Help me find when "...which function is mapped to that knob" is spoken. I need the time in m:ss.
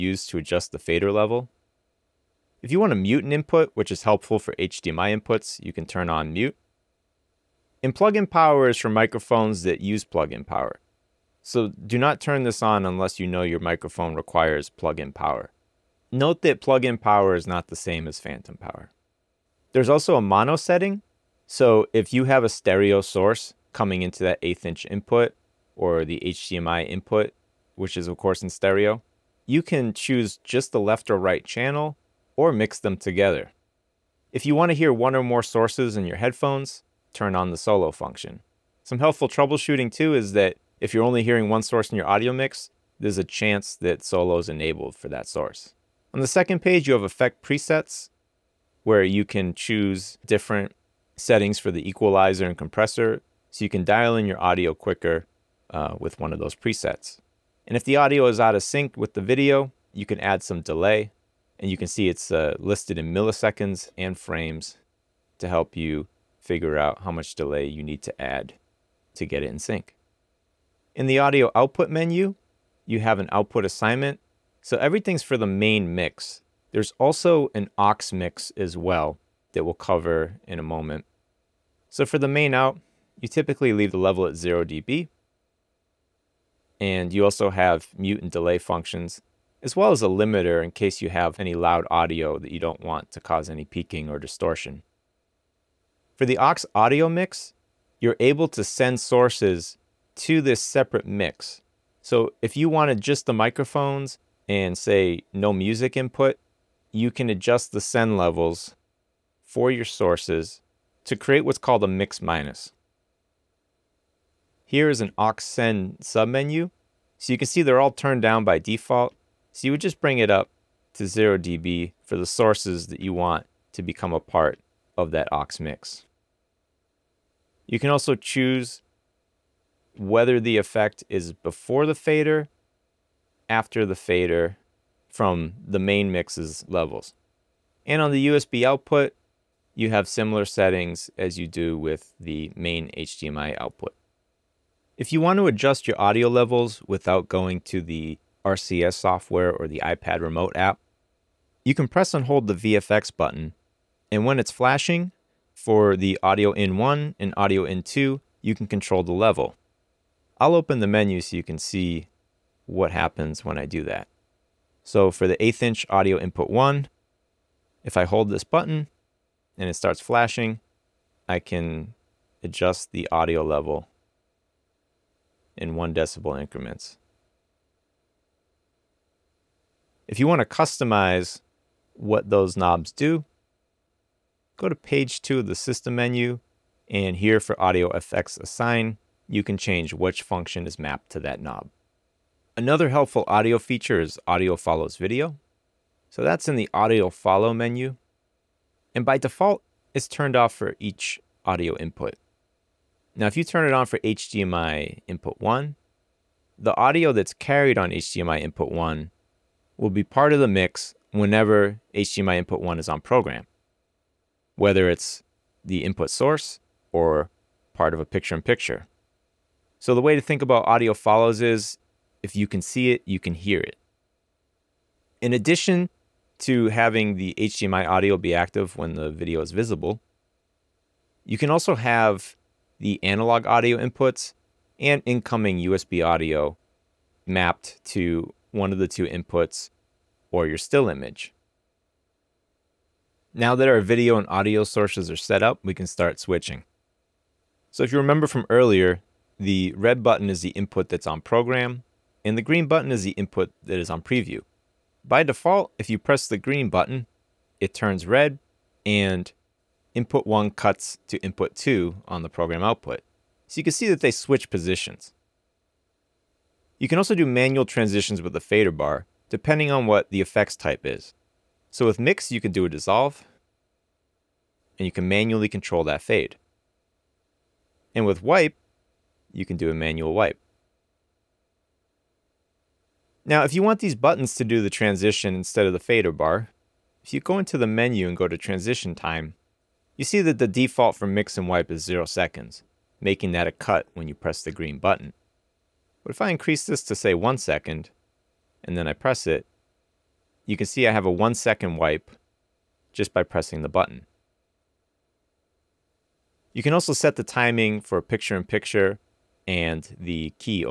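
3:09.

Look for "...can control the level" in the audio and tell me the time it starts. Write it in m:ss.
2:38.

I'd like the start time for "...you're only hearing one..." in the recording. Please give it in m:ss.
0:40.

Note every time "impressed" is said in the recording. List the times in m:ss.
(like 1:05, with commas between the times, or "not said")
not said.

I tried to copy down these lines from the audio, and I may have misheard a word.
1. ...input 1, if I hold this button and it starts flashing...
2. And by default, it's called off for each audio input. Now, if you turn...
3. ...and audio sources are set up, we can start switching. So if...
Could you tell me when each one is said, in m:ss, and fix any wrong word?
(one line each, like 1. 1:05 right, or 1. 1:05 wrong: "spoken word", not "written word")
1. 2:46 right
2. 3:18 wrong: "turned", not "called"
3. 4:04 right.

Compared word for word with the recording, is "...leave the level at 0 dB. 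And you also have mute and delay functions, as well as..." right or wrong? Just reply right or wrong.
right.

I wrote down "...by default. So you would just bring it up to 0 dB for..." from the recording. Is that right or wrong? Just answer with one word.
right.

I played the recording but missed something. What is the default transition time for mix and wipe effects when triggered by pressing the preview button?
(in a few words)
0 seconds.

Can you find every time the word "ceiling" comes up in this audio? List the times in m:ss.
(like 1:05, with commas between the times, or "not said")
not said.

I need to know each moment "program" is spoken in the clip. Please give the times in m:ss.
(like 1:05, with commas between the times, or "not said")
3:33, 4:11, 4:22.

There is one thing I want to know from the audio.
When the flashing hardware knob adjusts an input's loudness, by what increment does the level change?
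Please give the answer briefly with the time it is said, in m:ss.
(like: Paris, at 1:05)
one decibel, at 2:55.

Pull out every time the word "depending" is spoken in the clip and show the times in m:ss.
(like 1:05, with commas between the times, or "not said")
4:29.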